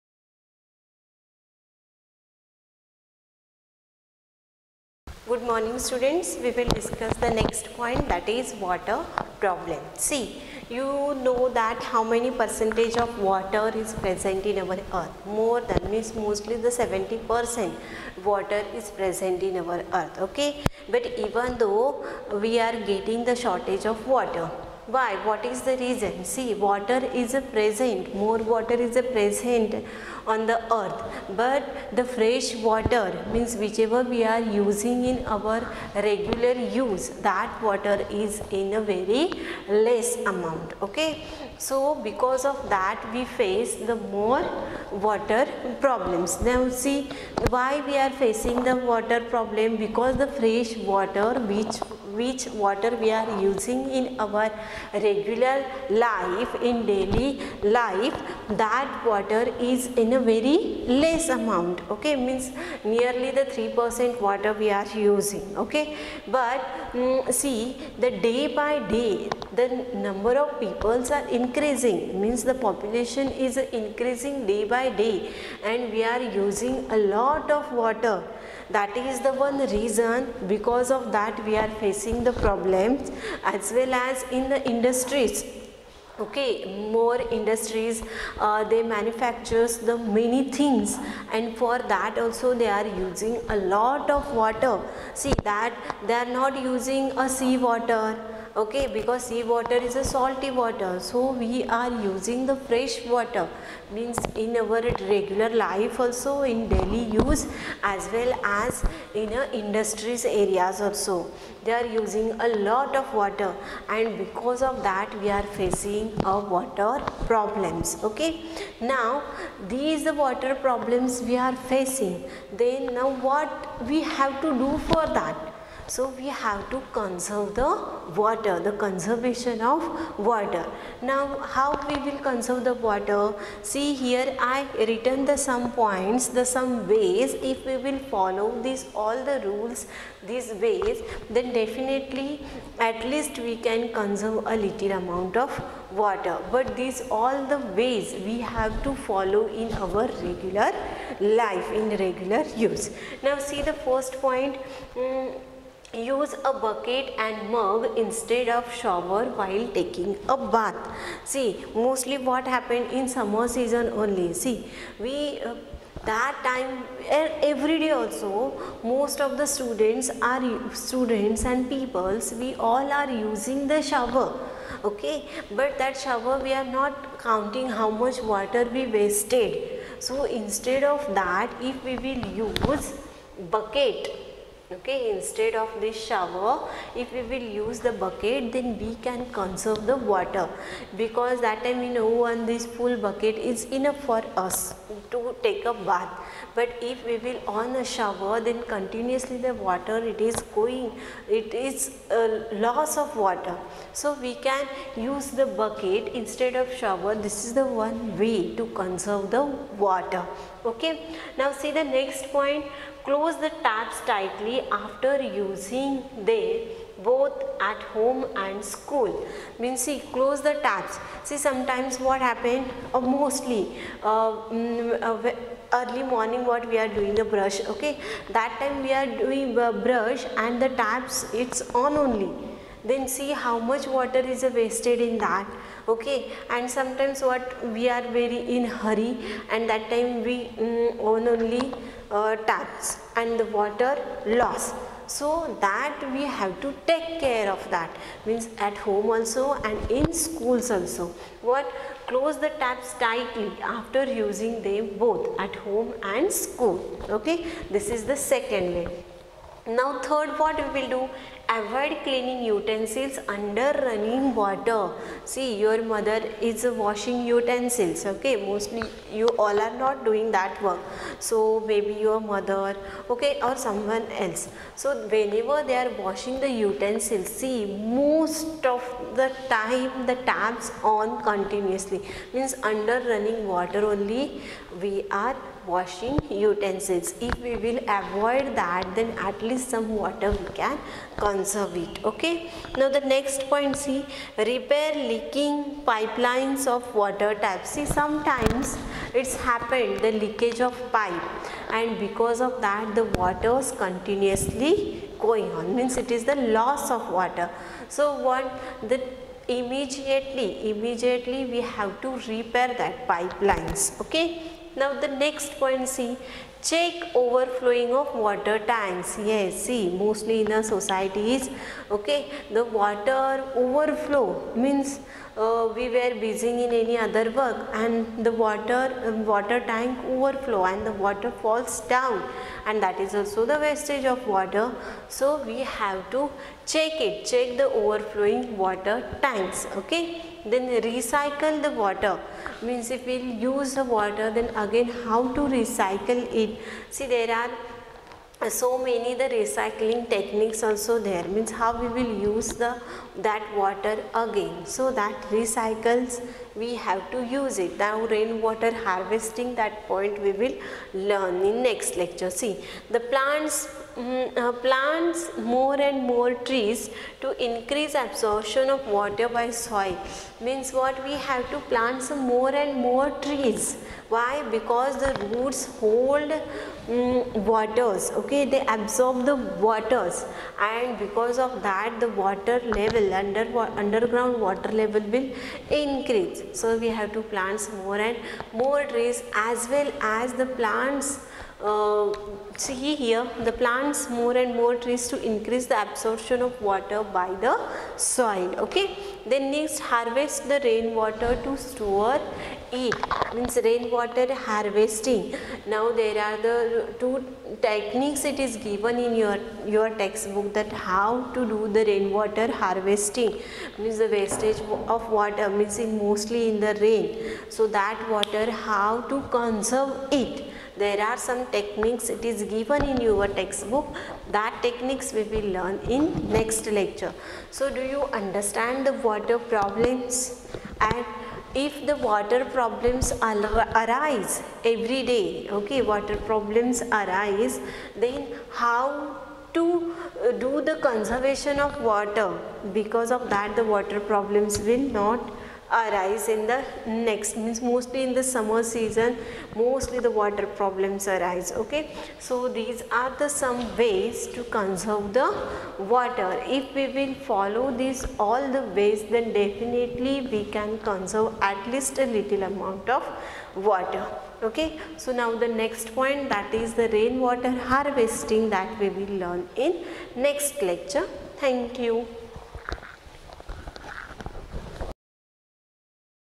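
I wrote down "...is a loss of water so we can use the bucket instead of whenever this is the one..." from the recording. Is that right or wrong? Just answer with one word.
wrong.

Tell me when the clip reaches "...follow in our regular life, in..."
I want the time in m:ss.
2:29.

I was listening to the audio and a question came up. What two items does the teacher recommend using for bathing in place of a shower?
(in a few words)
bucket and mug.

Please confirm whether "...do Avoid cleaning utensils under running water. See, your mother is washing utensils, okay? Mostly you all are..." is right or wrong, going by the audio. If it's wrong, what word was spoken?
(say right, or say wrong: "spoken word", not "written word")
right.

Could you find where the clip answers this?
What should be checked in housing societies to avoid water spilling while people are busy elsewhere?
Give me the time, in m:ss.
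5:17.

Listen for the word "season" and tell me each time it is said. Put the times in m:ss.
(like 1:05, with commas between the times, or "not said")
2:43, 7:28.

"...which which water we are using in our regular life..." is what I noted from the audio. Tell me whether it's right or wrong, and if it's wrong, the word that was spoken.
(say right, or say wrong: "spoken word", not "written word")
right.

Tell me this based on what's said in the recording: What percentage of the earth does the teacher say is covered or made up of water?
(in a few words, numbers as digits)
70 percent.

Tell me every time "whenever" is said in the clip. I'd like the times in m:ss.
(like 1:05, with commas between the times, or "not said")
4:35.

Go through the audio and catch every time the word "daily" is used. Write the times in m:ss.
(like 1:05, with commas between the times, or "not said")
0:56, 1:46.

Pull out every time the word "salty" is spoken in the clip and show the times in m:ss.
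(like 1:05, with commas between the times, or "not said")
1:40.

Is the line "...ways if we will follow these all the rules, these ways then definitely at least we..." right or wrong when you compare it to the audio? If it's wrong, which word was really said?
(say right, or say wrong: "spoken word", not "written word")
right.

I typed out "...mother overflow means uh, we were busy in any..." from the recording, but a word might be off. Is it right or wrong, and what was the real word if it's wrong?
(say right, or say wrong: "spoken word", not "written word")
wrong: "water", not "mother".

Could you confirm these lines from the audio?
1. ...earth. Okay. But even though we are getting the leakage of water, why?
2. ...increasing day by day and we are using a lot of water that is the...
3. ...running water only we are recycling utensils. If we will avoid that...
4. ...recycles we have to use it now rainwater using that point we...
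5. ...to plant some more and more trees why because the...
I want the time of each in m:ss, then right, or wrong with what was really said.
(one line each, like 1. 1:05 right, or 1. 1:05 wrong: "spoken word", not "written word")
1. 0:20 wrong: "shortage", not "leakage"
2. 1:13 right
3. 4:43 wrong: "washing", not "recycling"
4. 5:55 wrong: "harvesting", not "using"
5. 6:11 right.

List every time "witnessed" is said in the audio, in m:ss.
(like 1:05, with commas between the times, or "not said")
not said.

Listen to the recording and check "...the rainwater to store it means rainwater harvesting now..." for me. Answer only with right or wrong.
right.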